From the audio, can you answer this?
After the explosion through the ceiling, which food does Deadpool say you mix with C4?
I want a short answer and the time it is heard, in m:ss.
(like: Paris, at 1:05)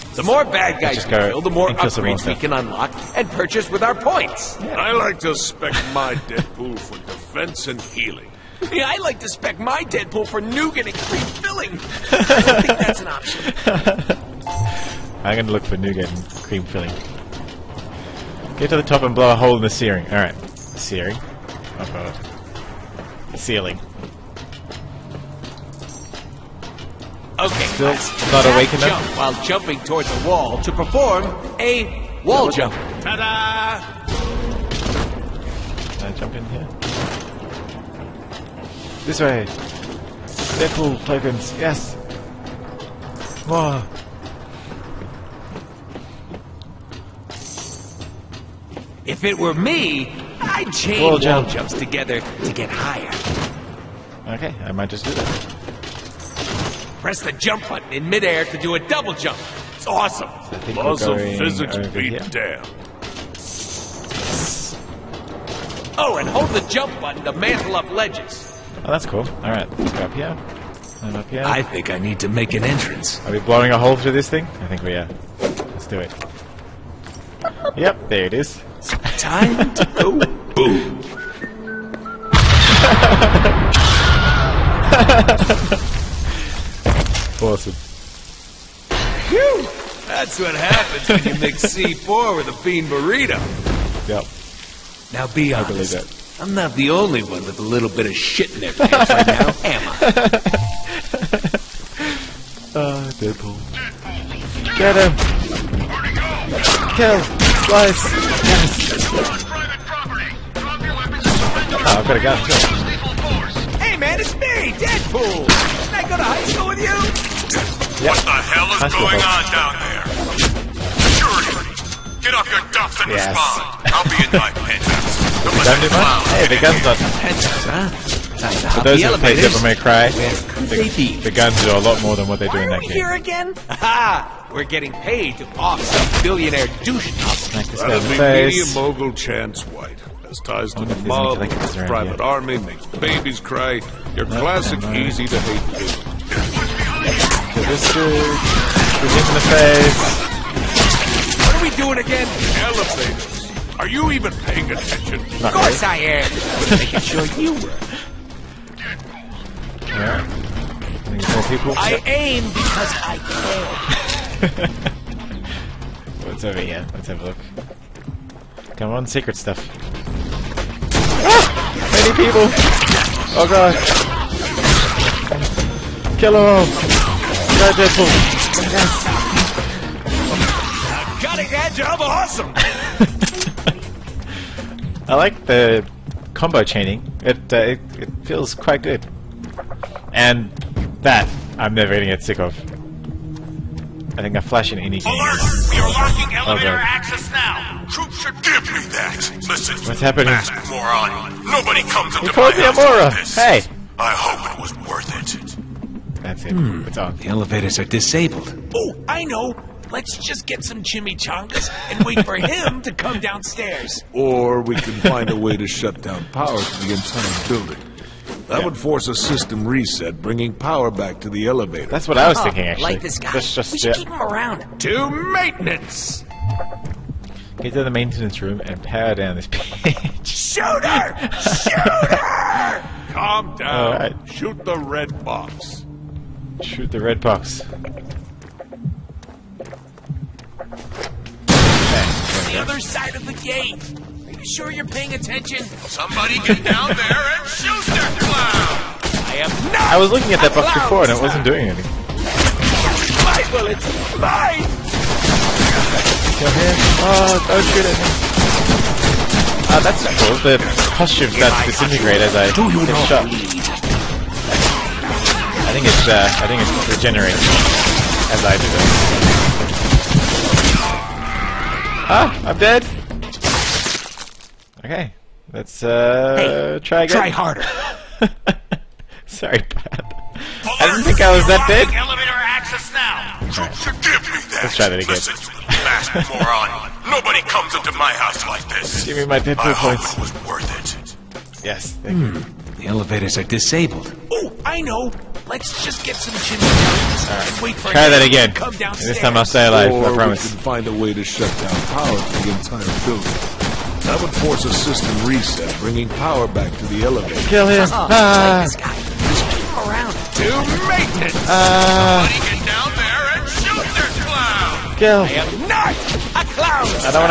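a bean burrito, at 1:32.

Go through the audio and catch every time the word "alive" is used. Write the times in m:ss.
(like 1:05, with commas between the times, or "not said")
4:59.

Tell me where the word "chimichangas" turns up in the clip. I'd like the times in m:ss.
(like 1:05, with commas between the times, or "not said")
3:30, 4:56.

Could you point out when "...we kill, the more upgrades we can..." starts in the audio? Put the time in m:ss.
0:01.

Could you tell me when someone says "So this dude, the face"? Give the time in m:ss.
2:27.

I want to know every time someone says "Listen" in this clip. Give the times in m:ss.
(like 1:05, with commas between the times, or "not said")
3:19, 4:45.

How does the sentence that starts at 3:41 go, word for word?
That's what I was oh, thinking, actually.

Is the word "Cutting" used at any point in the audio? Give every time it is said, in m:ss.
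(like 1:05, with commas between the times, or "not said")
3:01.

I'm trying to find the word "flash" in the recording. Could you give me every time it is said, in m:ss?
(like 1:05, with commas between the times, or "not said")
3:14.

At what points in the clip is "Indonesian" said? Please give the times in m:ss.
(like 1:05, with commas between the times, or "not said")
not said.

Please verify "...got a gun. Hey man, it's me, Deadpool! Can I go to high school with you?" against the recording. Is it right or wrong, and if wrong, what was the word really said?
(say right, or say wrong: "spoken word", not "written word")
right.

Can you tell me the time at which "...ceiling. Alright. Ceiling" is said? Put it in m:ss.
0:19.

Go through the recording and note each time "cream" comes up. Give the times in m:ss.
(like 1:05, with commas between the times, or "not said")
0:10, 0:16.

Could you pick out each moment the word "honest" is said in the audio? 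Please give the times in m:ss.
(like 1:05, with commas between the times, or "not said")
1:35.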